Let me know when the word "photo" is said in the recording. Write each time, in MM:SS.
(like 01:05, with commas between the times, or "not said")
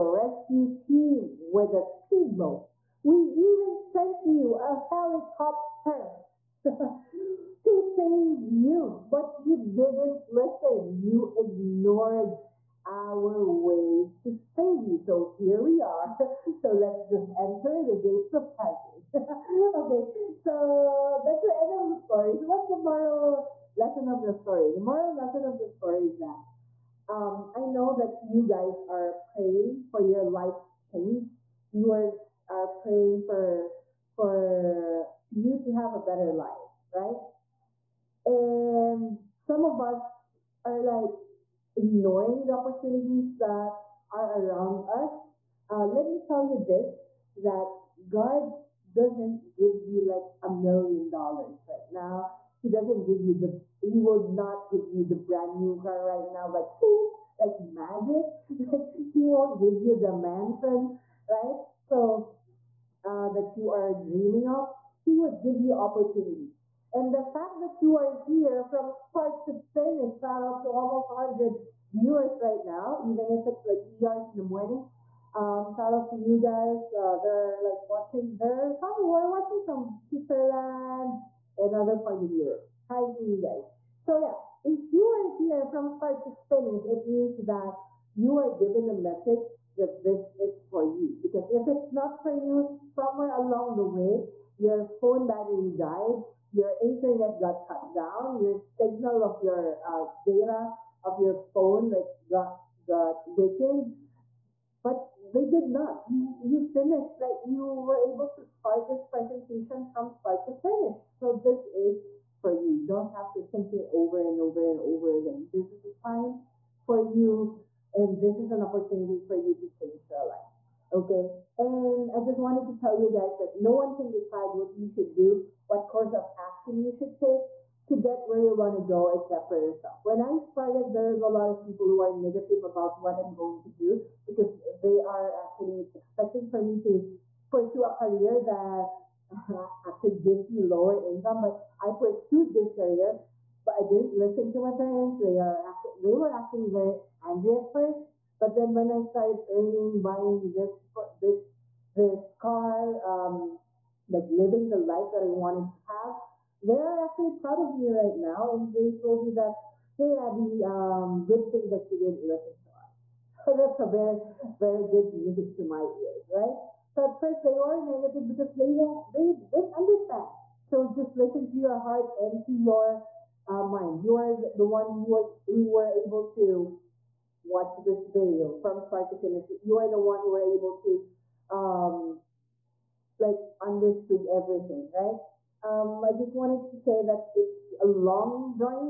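not said.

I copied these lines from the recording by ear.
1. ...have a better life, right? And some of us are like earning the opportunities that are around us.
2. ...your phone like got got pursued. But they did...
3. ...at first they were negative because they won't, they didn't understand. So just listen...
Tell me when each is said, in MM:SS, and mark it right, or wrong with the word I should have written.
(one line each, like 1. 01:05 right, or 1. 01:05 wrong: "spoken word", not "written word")
1. 00:35 wrong: "ignoring", not "earning"
2. 01:41 wrong: "weakened", not "pursued"
3. 02:47 right.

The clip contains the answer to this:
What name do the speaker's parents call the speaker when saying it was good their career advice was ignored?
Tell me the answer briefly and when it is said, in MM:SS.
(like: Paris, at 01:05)
Abie, at 02:40.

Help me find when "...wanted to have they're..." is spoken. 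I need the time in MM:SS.
02:35.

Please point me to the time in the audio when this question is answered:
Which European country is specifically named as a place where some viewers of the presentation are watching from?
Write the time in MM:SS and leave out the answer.
01:20.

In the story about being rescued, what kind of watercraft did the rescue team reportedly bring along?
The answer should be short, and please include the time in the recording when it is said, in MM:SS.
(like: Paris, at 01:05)
speedboat, at 00:01.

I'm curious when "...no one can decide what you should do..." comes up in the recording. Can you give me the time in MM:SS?
02:03.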